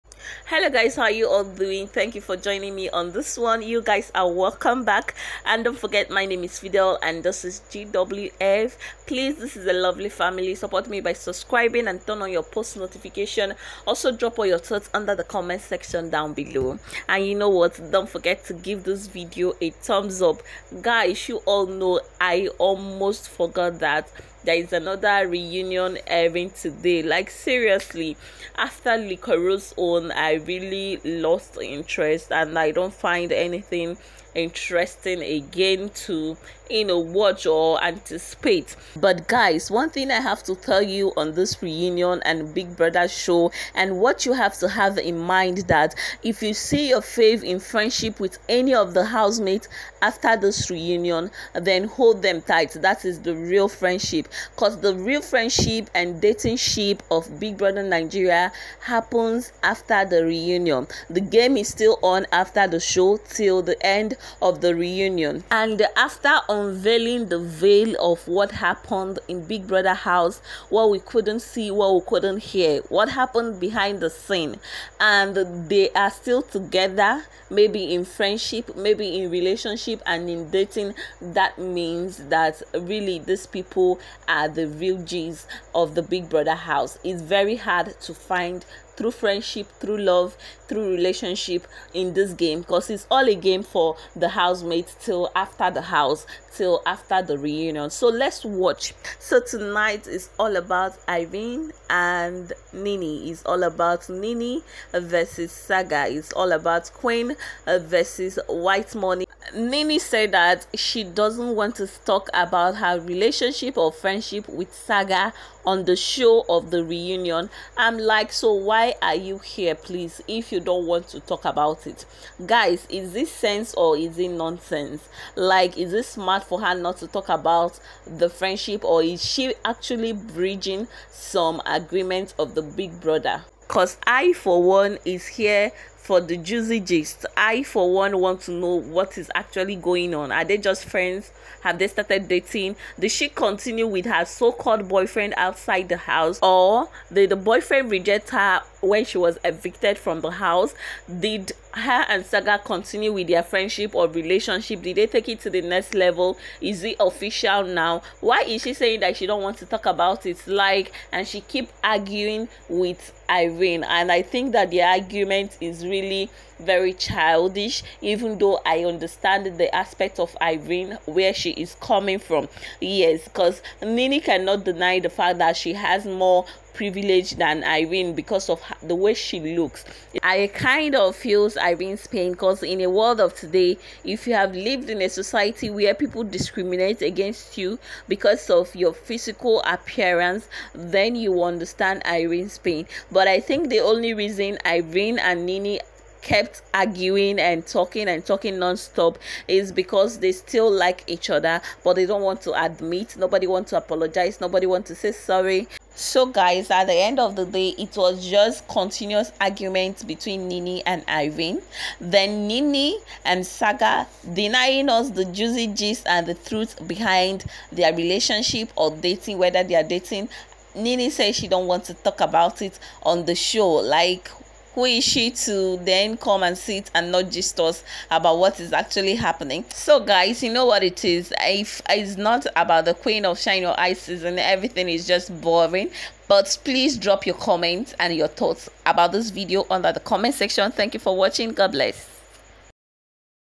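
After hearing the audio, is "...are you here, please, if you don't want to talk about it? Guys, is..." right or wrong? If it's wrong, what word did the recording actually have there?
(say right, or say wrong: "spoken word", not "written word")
right.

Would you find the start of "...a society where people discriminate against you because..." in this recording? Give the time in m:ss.
3:05.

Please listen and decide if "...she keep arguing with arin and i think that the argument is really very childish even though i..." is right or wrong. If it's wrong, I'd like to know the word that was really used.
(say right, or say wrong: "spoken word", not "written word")
right.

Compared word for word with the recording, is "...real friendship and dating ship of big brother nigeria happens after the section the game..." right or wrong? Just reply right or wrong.
wrong.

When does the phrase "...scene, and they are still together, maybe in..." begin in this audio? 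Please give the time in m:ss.
1:14.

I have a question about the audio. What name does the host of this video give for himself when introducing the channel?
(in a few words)
Fidel.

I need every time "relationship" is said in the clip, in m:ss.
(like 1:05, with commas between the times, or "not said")
1:19, 1:30, 1:53, 2:34, 3:37.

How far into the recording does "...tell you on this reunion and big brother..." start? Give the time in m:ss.
0:40.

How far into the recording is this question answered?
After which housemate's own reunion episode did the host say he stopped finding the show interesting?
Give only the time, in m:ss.
0:28.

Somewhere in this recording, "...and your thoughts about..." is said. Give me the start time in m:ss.
3:57.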